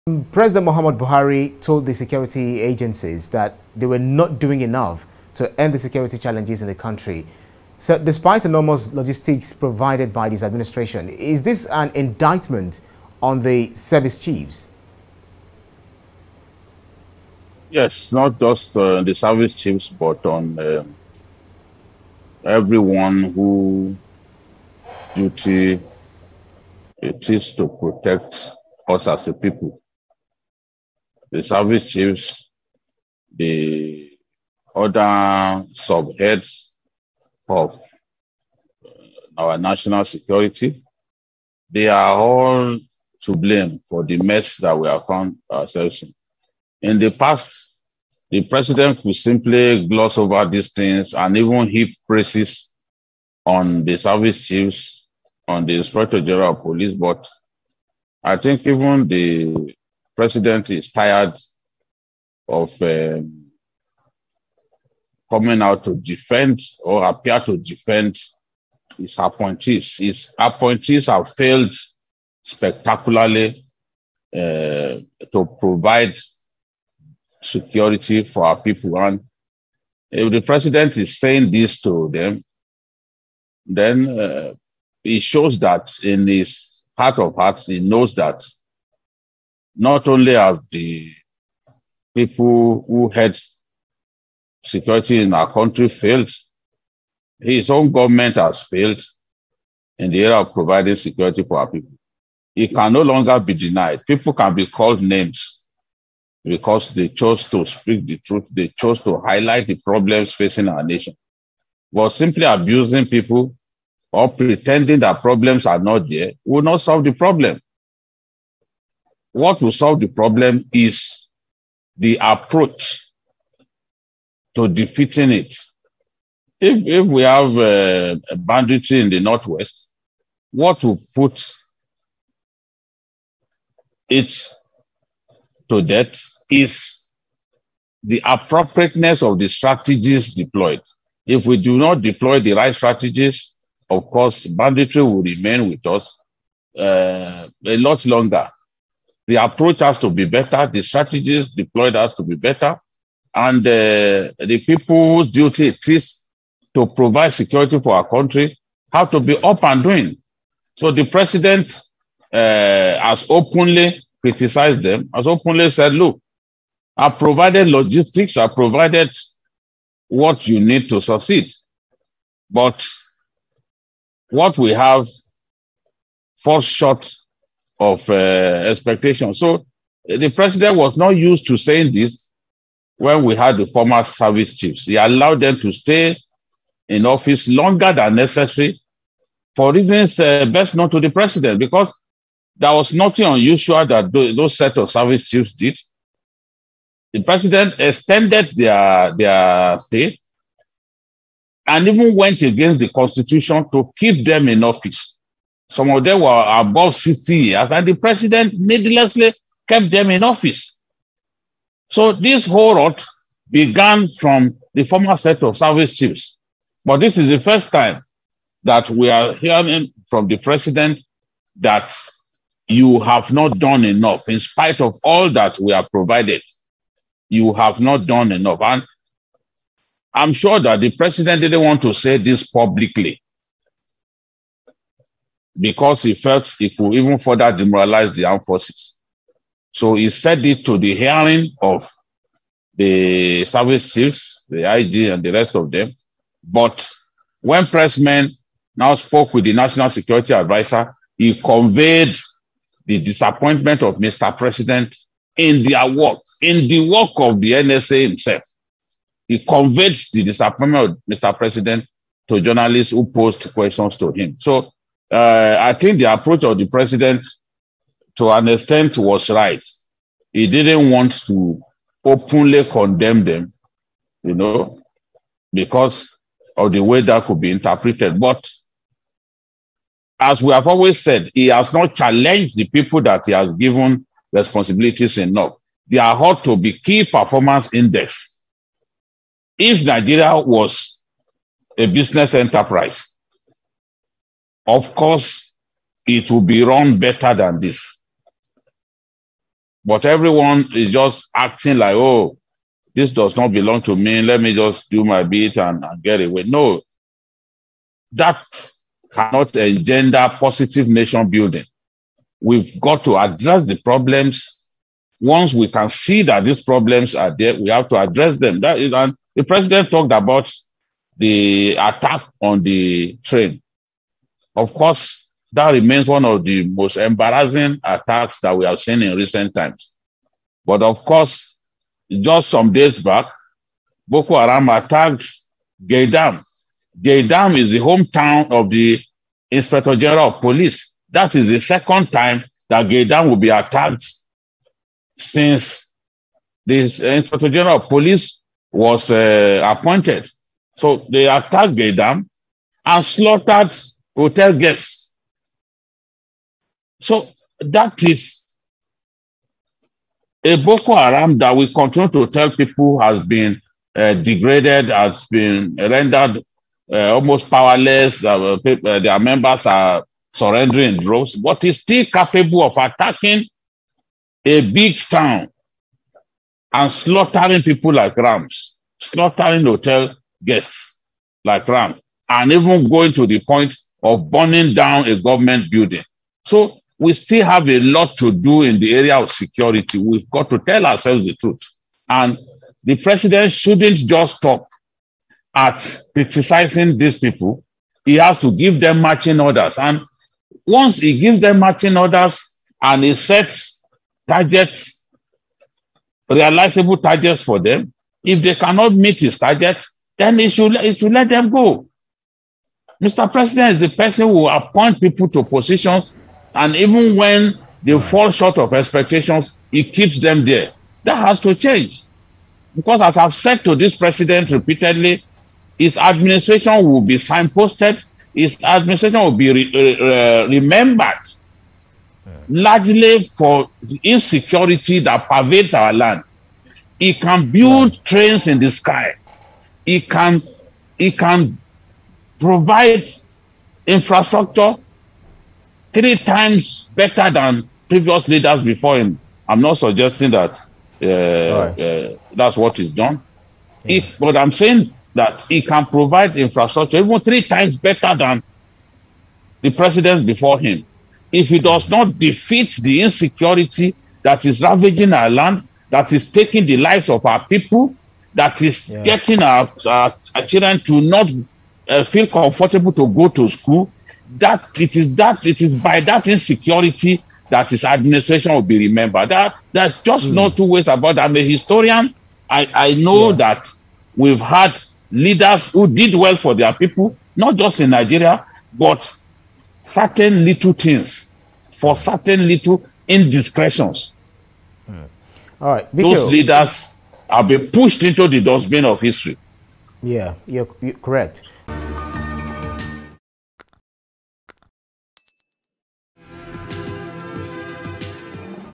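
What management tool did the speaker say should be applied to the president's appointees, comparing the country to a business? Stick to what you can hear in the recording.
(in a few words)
Key performance index.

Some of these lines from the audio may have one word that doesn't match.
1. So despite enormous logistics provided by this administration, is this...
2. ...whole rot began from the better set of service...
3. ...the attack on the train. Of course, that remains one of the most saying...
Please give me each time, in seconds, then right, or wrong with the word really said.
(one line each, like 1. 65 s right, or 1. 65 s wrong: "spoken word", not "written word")
1. 7 s right
2. 212 s wrong: "former", not "better"
3. 321 s wrong: "embarrassing", not "saying".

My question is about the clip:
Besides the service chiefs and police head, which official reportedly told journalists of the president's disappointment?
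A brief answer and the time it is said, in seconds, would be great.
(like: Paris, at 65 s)
National Security Advisor, at 249 s.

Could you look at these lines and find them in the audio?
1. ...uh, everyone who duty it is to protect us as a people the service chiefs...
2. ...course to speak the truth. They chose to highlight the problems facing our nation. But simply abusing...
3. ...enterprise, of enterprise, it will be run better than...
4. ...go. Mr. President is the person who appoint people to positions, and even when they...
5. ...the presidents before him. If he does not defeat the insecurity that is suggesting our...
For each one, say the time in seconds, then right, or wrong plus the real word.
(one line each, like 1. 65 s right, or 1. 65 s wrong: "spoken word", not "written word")
1. 20 s right
2. 107 s wrong: "chose", not "course"
3. 292 s wrong: "course", not "enterprise"
4. 411 s right
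5. 459 s wrong: "ravaging", not "suggesting".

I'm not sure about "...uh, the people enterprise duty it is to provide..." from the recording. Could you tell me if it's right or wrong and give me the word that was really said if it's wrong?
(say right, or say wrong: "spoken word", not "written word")
wrong: "whose", not "enterprise".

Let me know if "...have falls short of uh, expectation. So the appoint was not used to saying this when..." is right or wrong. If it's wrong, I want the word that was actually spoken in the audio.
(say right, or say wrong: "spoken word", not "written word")
wrong: "president", not "appoint".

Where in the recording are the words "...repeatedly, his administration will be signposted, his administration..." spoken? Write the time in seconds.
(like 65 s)
424 s.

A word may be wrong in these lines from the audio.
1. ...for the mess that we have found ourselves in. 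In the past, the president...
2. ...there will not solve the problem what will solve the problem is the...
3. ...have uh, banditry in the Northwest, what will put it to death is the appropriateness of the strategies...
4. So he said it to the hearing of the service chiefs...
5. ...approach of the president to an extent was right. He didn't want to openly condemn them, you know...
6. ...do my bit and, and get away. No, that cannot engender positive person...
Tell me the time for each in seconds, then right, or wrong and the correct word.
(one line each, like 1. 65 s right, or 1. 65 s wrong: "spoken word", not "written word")
1. 43 s right
2. 116 s right
3. 127 s right
4. 239 s right
5. 266 s right
6. 304 s wrong: "nation", not "person".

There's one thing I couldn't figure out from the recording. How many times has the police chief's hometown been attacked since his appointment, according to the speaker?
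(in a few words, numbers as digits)
2.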